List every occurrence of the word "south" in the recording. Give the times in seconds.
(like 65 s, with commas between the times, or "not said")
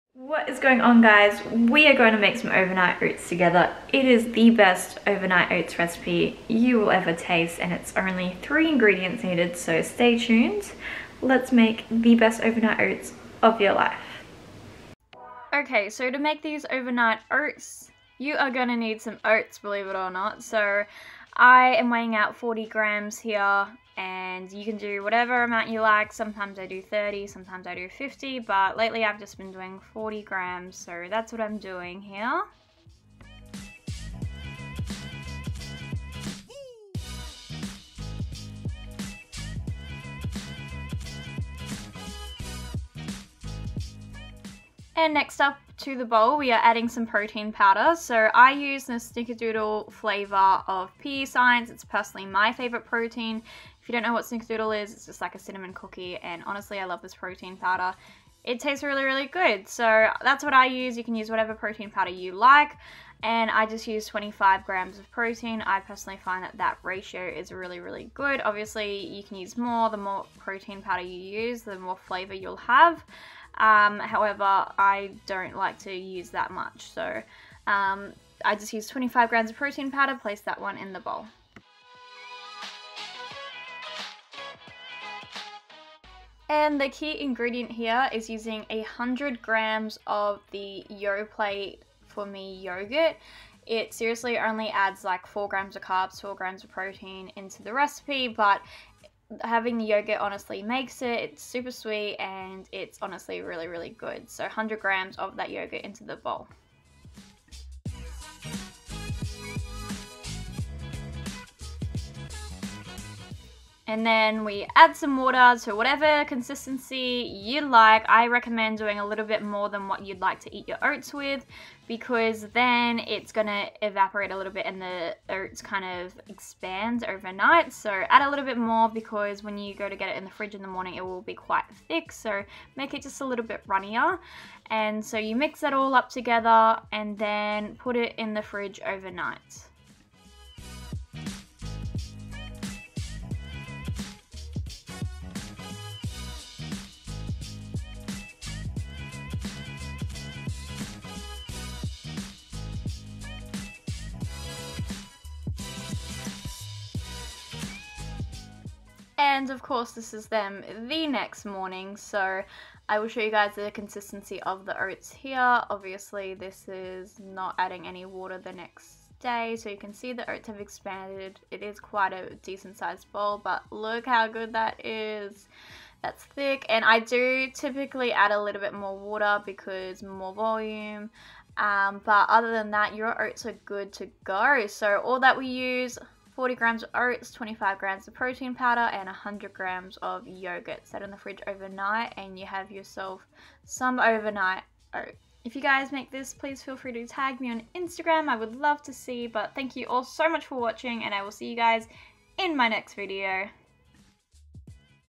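not said.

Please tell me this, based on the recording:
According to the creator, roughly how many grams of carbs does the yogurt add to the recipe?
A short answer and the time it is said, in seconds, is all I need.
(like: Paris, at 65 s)
4 grams, at 95 s.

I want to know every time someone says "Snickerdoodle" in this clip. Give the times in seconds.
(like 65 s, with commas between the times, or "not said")
48 s, 54 s.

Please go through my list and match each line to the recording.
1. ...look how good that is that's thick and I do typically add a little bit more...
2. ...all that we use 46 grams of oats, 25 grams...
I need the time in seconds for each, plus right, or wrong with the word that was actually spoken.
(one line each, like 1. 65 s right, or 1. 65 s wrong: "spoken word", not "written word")
1. 173 s right
2. 185 s wrong: "40", not "46".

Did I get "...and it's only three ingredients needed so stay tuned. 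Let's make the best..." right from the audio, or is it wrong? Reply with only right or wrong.
right.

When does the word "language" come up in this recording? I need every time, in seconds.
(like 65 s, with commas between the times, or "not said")
not said.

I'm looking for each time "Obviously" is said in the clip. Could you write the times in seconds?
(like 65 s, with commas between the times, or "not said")
68 s, 165 s.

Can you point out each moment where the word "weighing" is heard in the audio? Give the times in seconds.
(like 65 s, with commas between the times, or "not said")
21 s.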